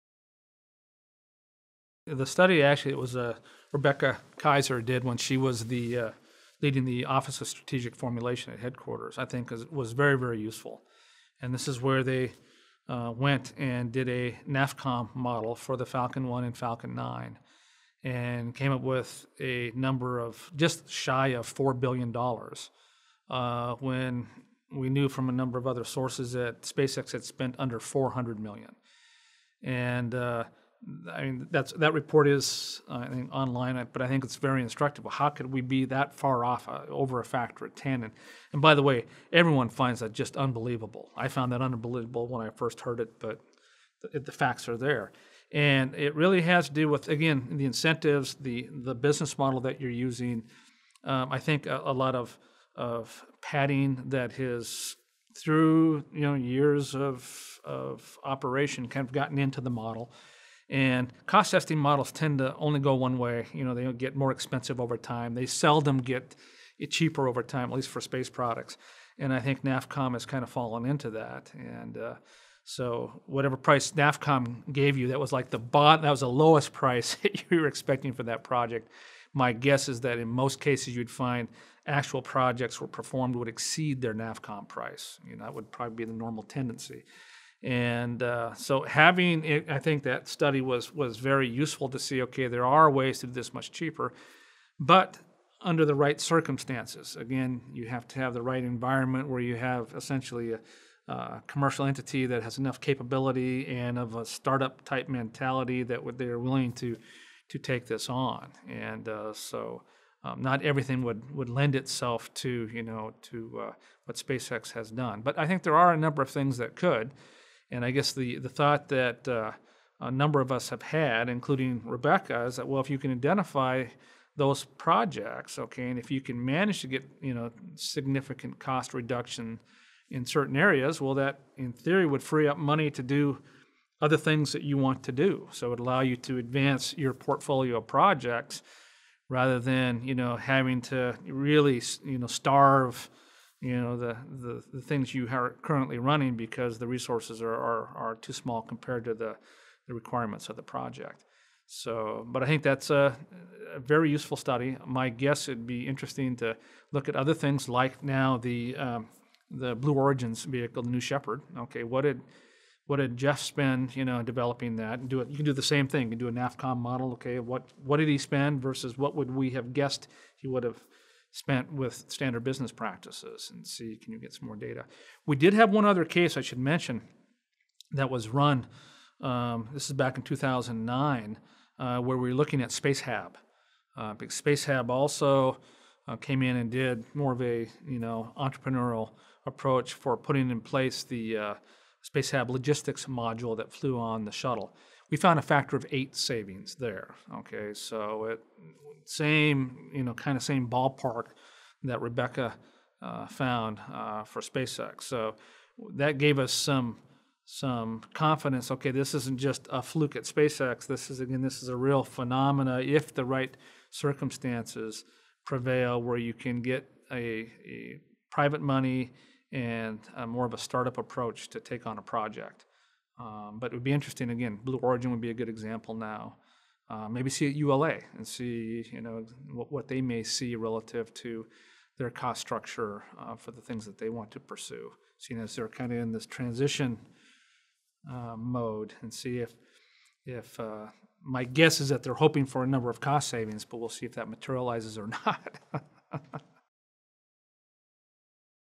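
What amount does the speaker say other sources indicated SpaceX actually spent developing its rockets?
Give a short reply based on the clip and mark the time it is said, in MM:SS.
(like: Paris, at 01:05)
under $400 million, at 00:27.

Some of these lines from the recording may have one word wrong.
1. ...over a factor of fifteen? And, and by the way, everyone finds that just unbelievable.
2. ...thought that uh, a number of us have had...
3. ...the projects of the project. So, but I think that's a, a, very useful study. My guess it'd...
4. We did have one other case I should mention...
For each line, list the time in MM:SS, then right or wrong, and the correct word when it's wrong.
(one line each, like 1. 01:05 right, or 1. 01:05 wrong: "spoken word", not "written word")
1. 00:36 wrong: "ten", not "fifteen"
2. 01:58 right
3. 02:29 wrong: "requirements", not "projects"
4. 02:55 right.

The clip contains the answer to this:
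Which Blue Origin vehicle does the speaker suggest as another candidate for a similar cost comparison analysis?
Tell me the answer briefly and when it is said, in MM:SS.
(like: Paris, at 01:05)
New Shepard, at 02:40.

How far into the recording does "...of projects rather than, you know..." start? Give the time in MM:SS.
02:17.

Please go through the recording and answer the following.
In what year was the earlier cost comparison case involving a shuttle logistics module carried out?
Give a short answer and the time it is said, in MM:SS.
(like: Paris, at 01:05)
2009, at 03:00.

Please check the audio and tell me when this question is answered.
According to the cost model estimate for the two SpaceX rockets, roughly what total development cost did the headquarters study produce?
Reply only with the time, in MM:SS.
00:20.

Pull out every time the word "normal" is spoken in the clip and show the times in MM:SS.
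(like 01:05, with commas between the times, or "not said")
01:26.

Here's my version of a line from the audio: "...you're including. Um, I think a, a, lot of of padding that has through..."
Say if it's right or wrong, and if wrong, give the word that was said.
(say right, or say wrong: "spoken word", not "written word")
wrong: "using", not "including".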